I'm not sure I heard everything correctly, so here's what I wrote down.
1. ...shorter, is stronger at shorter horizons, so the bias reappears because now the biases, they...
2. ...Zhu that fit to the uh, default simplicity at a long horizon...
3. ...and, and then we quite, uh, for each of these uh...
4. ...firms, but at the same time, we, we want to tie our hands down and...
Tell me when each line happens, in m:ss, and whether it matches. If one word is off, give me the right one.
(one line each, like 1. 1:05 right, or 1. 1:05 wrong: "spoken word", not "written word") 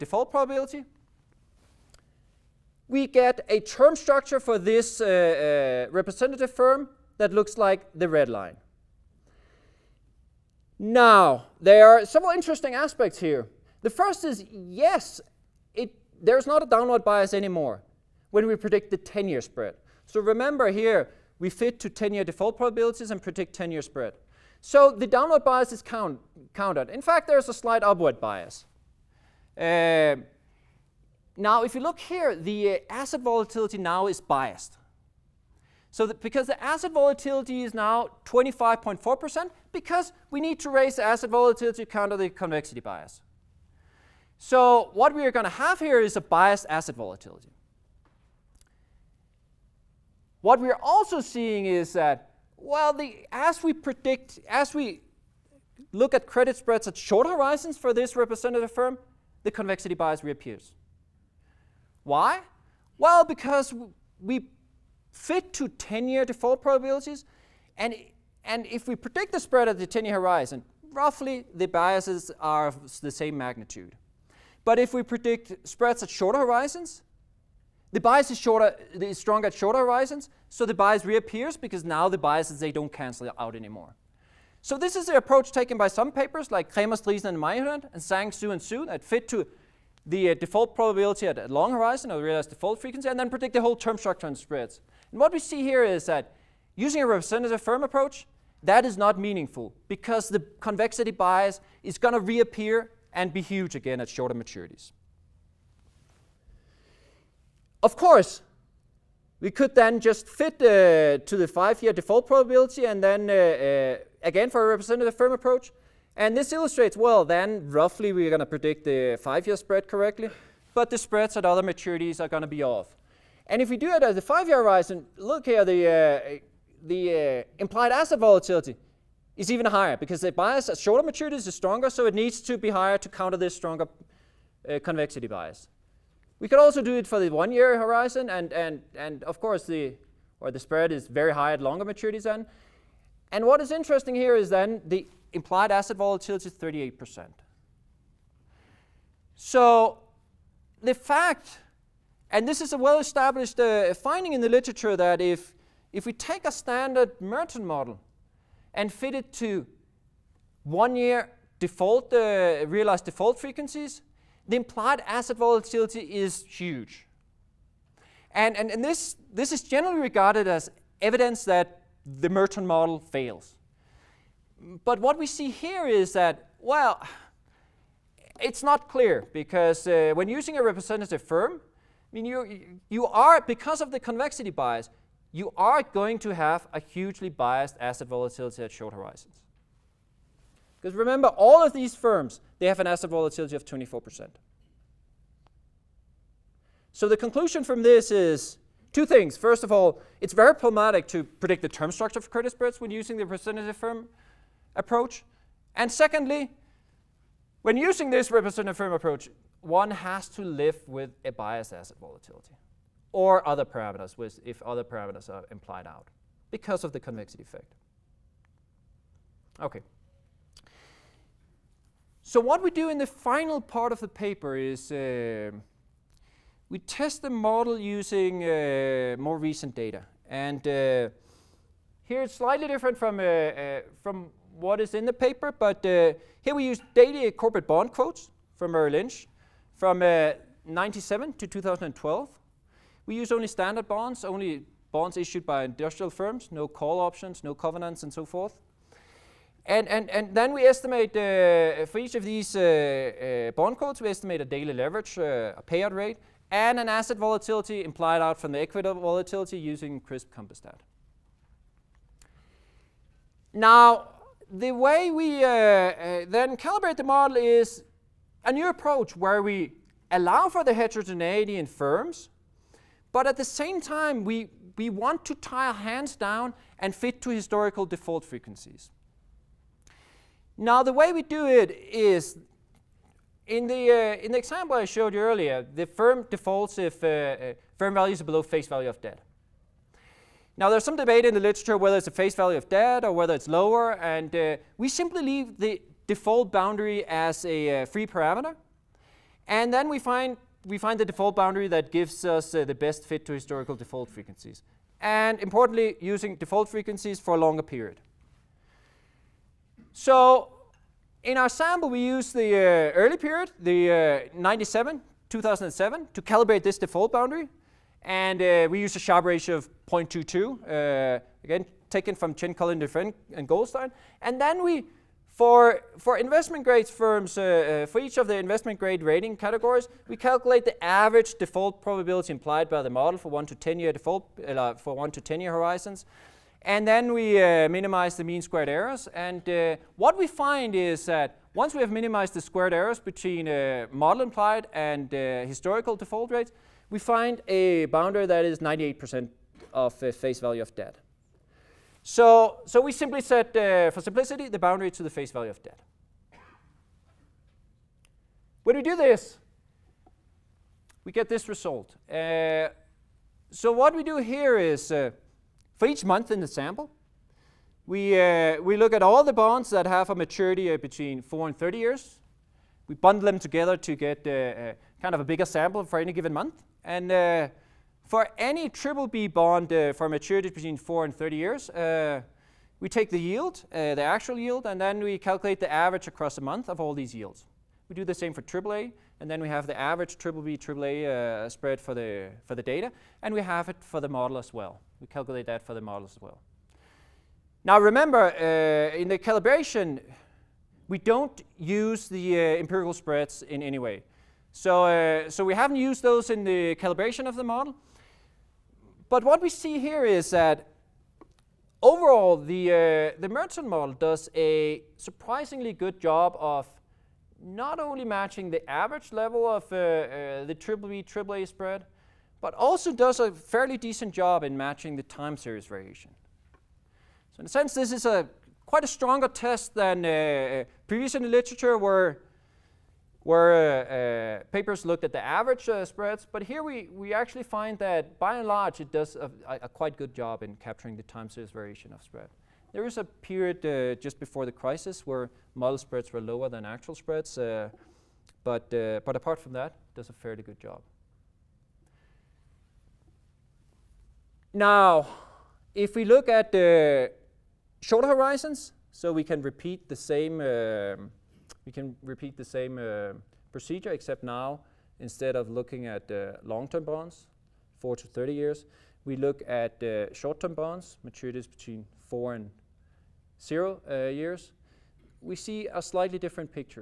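1. 1:18 right
2. 1:28 wrong: "probability", not "simplicity"
3. 4:09 wrong: "estimate", not "quite"
4. 4:31 right.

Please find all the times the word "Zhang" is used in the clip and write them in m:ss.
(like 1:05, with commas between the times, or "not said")
1:28.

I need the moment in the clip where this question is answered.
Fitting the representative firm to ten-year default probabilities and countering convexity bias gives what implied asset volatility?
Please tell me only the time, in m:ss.
0:38.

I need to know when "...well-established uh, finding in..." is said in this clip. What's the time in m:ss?
2:32.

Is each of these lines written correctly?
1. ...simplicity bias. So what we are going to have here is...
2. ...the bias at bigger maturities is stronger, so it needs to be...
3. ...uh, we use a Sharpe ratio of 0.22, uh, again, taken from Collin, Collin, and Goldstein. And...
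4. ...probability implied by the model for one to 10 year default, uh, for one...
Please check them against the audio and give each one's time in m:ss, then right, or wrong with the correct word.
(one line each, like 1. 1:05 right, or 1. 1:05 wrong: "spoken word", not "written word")
1. 0:42 wrong: "convexity", not "simplicity"
2. 2:10 wrong: "shorter", not "bigger"
3. 5:18 wrong: "Chen", not "Collin"
4. 5:31 right.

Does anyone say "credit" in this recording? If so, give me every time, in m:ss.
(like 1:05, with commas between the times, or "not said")
0:56, 3:22.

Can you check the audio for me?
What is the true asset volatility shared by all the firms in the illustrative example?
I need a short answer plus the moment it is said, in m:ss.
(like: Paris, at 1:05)
24%, at 3:13.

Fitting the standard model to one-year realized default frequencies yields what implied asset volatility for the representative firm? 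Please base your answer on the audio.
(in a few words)
38%.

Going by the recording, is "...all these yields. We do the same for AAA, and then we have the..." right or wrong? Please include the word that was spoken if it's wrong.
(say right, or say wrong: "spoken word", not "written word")
right.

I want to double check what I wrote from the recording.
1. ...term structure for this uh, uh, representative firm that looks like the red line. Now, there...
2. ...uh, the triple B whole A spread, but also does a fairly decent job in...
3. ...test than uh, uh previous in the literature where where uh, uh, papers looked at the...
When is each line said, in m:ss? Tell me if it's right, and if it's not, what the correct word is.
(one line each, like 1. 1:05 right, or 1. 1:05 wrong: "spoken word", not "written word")
1. 0:03 right
2. 6:59 wrong: "triple", not "whole"
3. 7:09 right.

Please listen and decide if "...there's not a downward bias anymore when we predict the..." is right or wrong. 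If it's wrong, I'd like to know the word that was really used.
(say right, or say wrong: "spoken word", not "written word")
right.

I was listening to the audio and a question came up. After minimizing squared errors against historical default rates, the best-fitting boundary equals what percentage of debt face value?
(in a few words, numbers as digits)
98%.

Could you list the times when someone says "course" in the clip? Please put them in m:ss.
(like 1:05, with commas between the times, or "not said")
1:47, 2:19.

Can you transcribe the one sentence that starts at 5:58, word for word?
When we do this, we get this result.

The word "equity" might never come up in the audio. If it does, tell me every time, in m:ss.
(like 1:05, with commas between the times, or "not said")
4:18.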